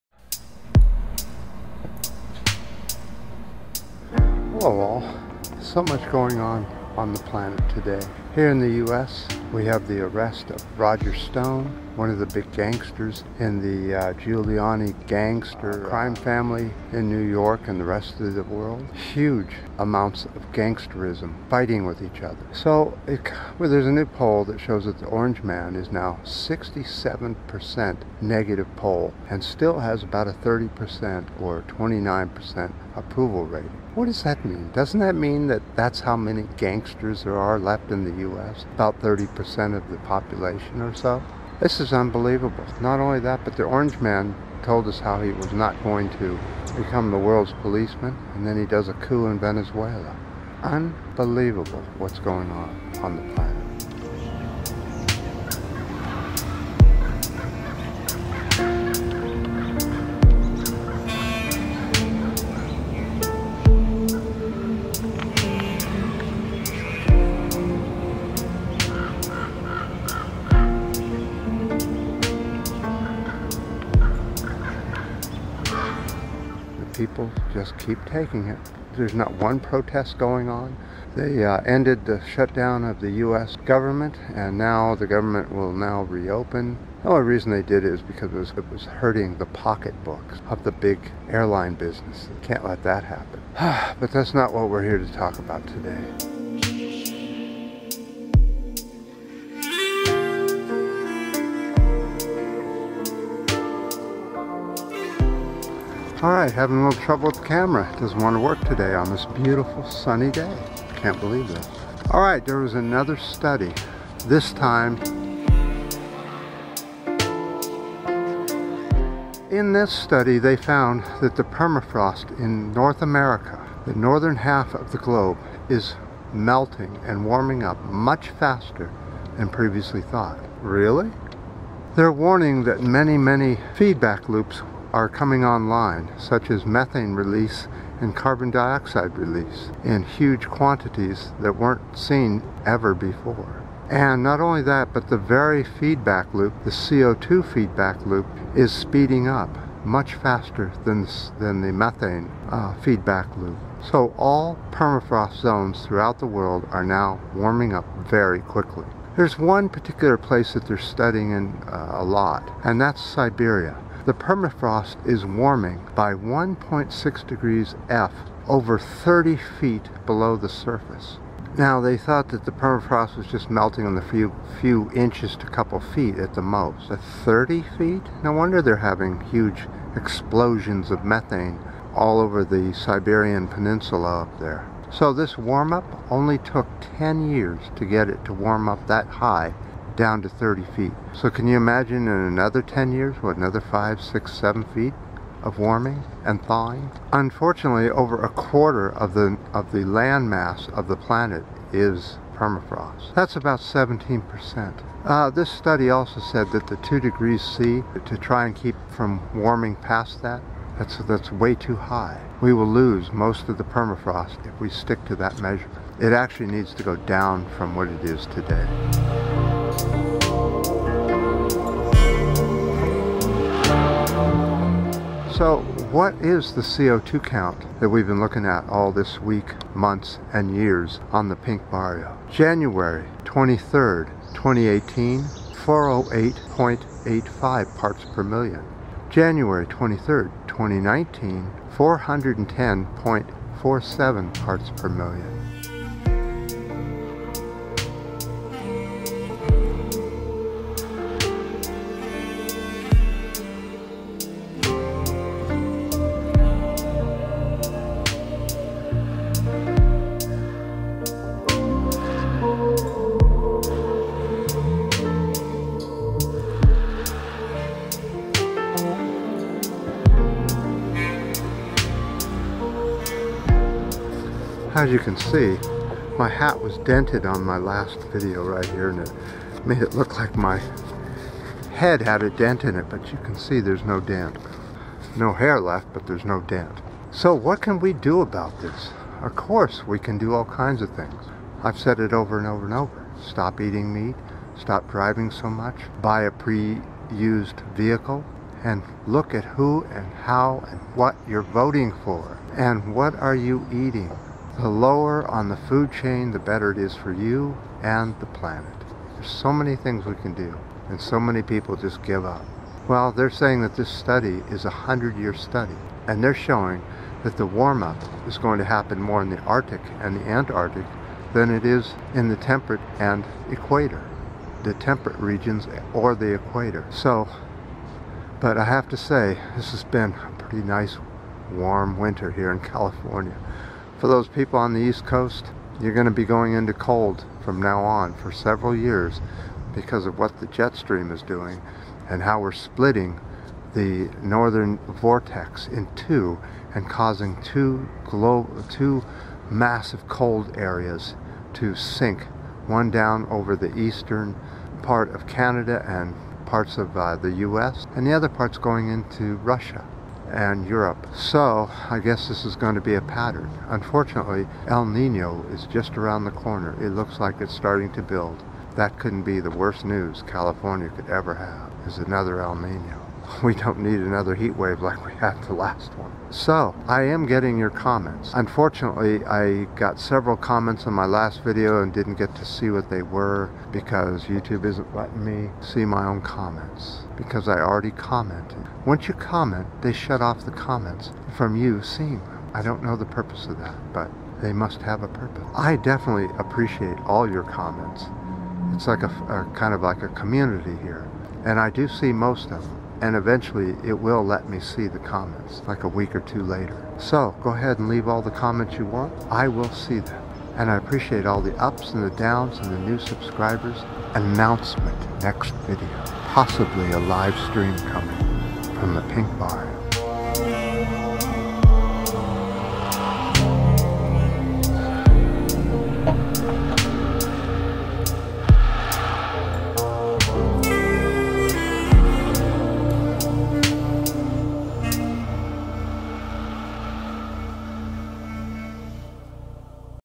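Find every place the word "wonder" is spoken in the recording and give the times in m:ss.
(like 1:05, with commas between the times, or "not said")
2:58.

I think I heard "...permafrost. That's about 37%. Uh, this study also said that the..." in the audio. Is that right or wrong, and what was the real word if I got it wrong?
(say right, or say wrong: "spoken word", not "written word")
wrong: "17", not "37".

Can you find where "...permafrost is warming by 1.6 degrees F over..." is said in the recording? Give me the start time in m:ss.
2:44.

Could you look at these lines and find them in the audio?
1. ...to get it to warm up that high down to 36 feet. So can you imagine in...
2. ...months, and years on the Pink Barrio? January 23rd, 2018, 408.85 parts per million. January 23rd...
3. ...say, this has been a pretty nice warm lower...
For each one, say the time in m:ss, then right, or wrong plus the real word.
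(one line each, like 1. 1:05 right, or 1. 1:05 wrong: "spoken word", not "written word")
1. 3:07 wrong: "30", not "36"
2. 3:49 right
3. 5:28 wrong: "winter", not "lower".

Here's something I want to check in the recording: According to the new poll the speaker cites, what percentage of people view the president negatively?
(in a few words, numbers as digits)
67%.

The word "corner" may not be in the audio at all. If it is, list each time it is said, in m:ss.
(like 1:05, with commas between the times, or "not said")
6:06.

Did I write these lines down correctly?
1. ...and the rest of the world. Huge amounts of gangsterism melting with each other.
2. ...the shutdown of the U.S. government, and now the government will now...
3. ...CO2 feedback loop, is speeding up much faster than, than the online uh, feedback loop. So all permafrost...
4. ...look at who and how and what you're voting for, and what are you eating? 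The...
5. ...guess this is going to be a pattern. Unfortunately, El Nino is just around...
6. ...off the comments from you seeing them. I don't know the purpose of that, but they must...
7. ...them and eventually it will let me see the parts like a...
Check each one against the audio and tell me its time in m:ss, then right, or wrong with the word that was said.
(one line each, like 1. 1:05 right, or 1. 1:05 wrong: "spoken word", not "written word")
1. 0:17 wrong: "fighting", not "melting"
2. 1:22 right
3. 2:26 wrong: "methane", not "online"
4. 4:59 right
5. 6:01 right
6. 6:30 right
7. 6:42 wrong: "comments", not "parts".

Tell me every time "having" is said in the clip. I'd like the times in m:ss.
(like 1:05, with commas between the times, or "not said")
1:46, 2:58.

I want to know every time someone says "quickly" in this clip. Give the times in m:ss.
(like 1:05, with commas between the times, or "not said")
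2:38.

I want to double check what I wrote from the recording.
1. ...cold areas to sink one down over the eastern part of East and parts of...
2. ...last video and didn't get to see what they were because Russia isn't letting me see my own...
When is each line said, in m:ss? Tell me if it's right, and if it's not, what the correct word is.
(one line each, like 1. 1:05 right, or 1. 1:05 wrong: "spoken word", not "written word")
1. 5:50 wrong: "Canada", not "East"
2. 6:21 wrong: "YouTube", not "Russia".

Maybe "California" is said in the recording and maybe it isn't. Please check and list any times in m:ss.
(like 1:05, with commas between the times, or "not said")
5:32, 6:10.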